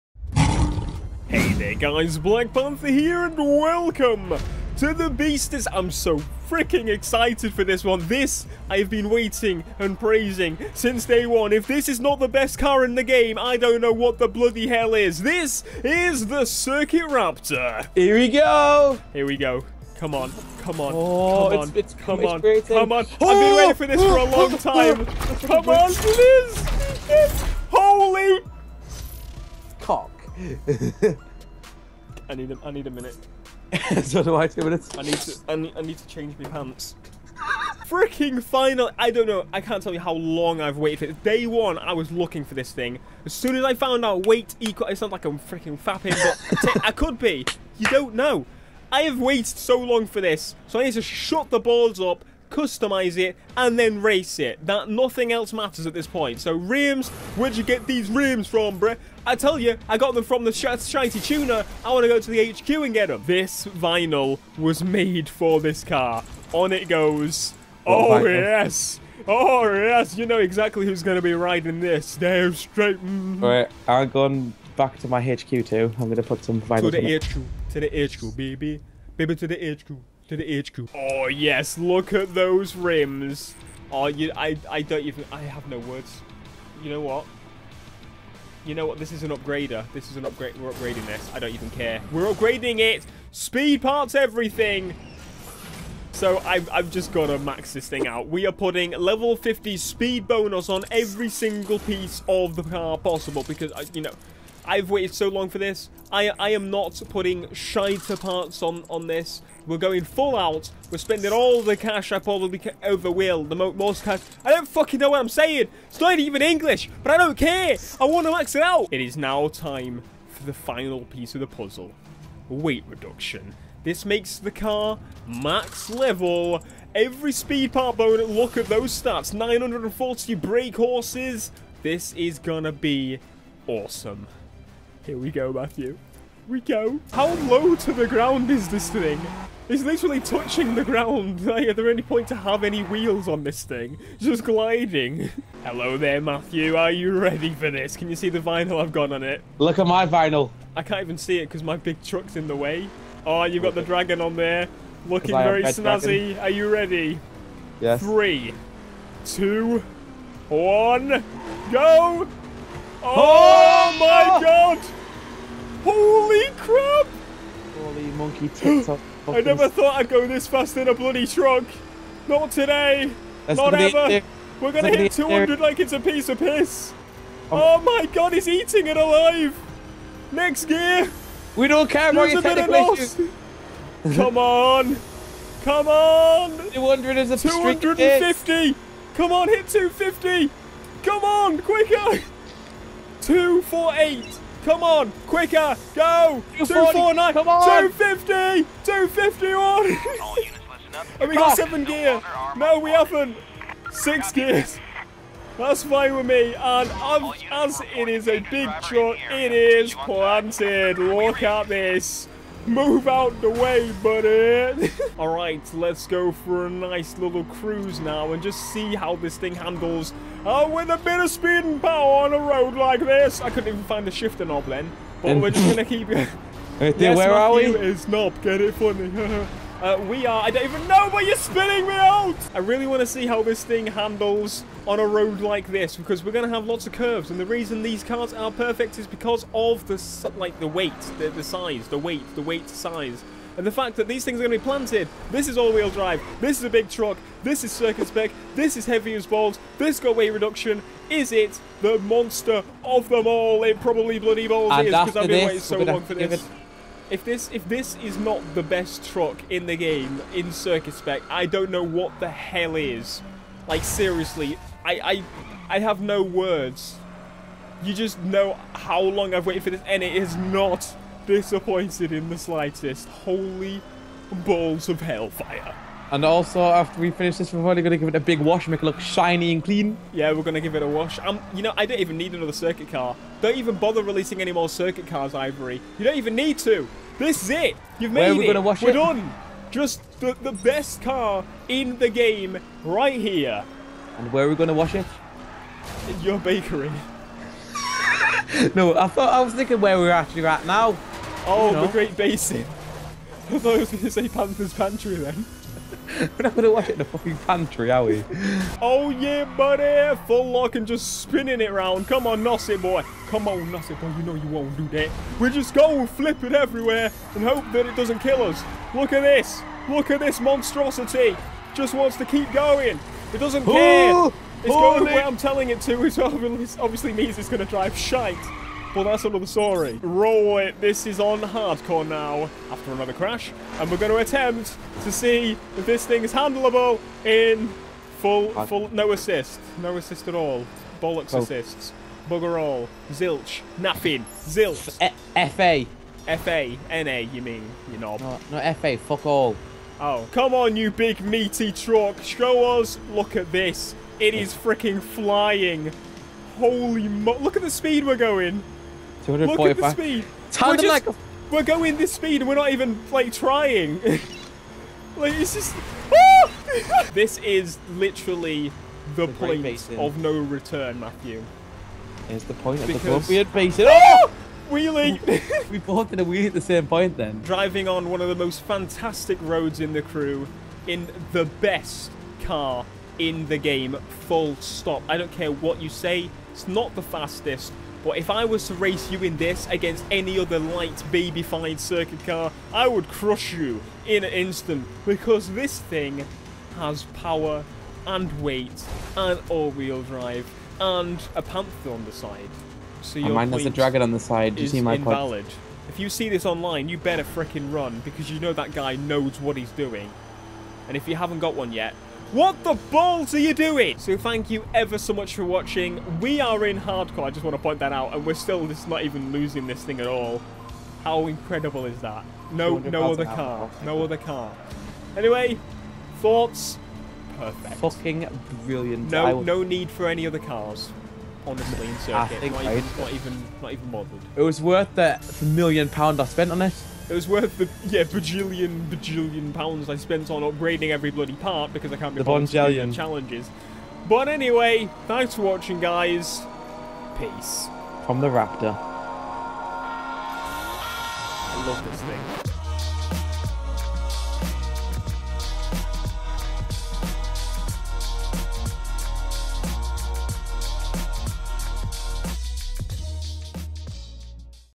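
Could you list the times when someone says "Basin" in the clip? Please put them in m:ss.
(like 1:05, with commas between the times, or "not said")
5:02, 6:13.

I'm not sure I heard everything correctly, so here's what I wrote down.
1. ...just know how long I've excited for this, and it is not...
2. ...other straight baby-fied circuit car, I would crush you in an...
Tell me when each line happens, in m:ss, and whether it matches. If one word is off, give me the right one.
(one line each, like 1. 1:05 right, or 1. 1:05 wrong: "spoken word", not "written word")
1. 4:27 wrong: "waited", not "excited"
2. 6:30 wrong: "light", not "straight".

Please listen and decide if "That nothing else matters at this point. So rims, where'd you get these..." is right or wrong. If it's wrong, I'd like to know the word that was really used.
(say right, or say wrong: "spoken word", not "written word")
right.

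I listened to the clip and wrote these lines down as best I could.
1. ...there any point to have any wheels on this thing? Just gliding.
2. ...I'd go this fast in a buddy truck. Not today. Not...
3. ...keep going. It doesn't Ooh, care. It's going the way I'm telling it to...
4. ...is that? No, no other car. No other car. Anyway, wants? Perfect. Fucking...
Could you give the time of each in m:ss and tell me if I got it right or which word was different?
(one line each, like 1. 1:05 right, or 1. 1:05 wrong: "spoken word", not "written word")
1. 2:21 right
2. 2:49 wrong: "bloody", not "buddy"
3. 5:22 right
4. 7:01 wrong: "thoughts", not "wants".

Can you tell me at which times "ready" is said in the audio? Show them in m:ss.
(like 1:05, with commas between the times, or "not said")
2:27, 2:36.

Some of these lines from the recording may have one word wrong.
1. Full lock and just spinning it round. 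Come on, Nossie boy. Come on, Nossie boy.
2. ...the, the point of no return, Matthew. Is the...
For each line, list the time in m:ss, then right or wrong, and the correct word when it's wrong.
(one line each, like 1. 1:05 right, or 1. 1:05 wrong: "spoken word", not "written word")
1. 5:10 right
2. 6:09 right.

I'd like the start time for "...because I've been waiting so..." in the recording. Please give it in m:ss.
4:14.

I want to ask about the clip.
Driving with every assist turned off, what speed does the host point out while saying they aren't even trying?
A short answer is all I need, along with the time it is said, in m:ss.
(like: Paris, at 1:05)
245, at 5:59.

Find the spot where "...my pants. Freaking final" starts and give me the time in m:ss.
0:36.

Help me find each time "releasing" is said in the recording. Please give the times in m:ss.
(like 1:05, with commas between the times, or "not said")
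4:44.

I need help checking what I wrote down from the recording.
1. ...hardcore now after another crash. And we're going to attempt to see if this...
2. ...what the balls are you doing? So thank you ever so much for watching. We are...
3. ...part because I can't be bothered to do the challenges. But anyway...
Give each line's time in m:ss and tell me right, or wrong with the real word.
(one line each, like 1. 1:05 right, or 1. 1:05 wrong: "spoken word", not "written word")
1. 5:31 right
2. 6:52 right
3. 7:21 right.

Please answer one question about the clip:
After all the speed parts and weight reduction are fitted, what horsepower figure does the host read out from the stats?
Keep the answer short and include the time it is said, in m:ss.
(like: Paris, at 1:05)
940, at 2:09.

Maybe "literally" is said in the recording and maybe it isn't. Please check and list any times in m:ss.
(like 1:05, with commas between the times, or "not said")
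2:19, 6:07.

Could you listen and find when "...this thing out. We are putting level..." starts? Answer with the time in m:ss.
1:37.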